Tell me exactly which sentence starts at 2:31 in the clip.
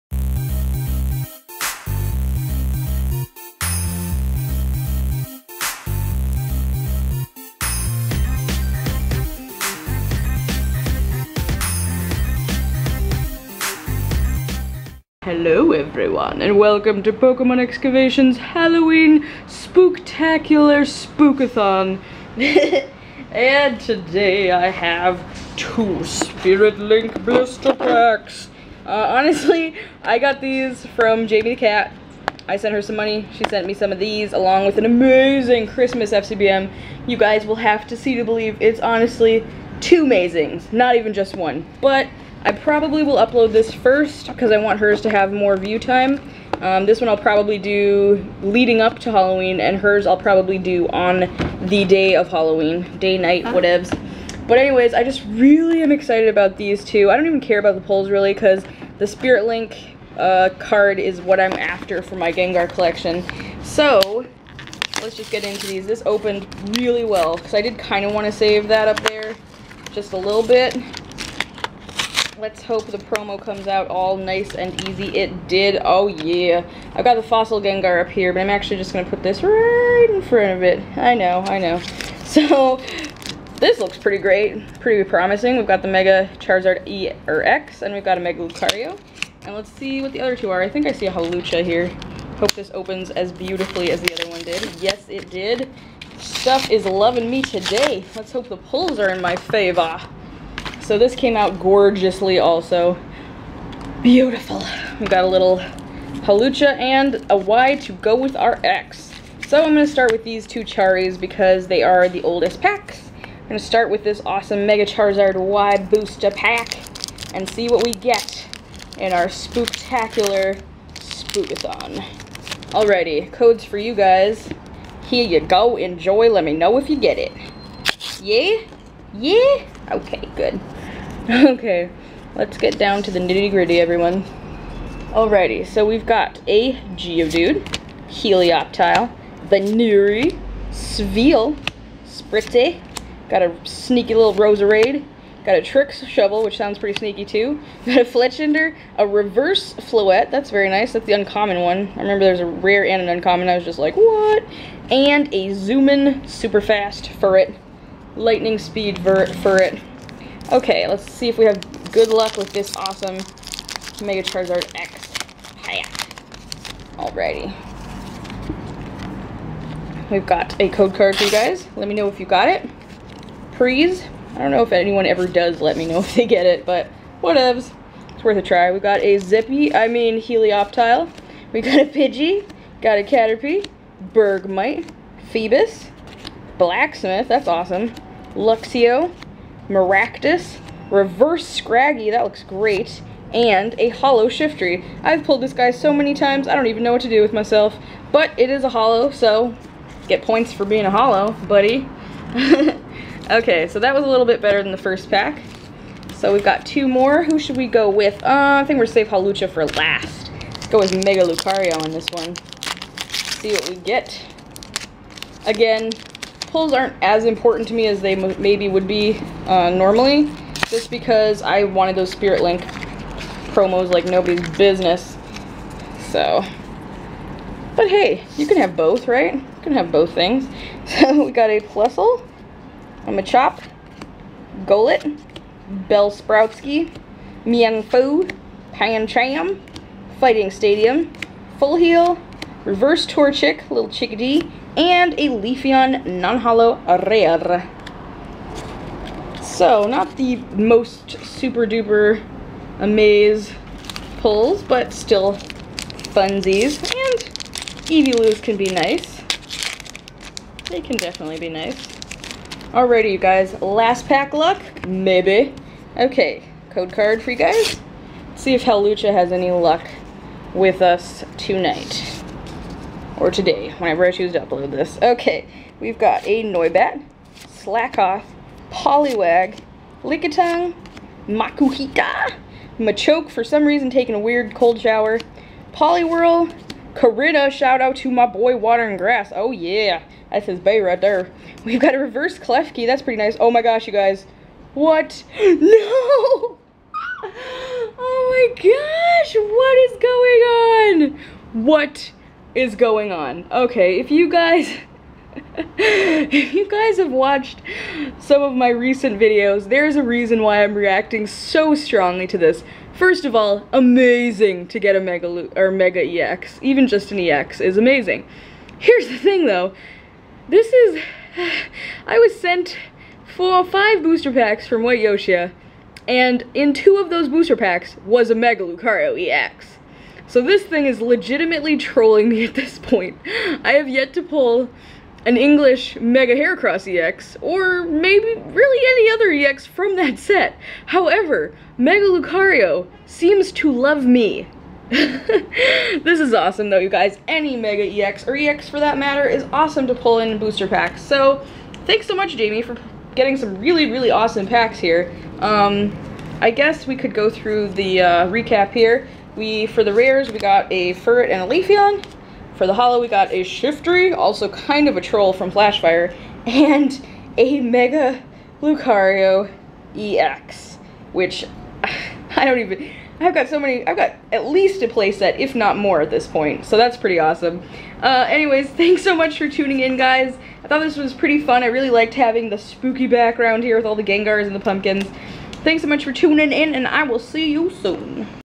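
I remember there's a rare and an uncommon, I was just like, what?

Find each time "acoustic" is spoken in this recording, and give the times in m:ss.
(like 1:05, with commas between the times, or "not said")
not said.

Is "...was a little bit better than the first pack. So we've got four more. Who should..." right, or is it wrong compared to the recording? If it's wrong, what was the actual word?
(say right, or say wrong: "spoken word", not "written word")
wrong: "two", not "four".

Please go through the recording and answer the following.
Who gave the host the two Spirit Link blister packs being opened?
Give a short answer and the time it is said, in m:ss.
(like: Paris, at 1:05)
Jamie the Cat, at 0:31.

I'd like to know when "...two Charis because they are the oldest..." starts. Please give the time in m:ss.
1:50.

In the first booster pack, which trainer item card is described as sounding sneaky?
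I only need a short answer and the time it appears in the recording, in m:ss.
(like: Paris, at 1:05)
Tricks Shovel, at 2:25.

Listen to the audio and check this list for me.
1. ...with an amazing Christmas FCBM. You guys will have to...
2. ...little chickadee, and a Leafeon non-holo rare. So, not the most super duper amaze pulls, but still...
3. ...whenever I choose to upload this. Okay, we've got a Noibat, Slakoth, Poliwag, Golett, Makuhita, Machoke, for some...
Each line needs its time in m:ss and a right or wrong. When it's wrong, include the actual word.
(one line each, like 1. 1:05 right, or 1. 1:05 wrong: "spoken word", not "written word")
1. 0:34 right
2. 4:03 right
3. 4:33 wrong: "Lickitung", not "Golett".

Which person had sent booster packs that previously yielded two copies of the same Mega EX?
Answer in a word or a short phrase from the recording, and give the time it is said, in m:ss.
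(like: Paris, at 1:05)
White Yoshia, at 5:24.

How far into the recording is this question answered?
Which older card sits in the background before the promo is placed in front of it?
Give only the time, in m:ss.
1:17.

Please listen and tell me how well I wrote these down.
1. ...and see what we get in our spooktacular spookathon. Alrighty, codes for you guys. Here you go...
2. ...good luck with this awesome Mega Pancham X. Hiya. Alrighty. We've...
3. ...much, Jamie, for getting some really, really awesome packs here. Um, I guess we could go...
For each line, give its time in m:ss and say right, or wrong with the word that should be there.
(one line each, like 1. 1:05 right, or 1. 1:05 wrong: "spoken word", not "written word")
1. 1:57 right
2. 2:41 wrong: "Charizard", not "Pancham"
3. 5:52 right.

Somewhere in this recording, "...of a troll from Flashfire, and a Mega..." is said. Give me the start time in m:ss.
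6:04.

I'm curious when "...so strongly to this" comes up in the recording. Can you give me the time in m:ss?
5:11.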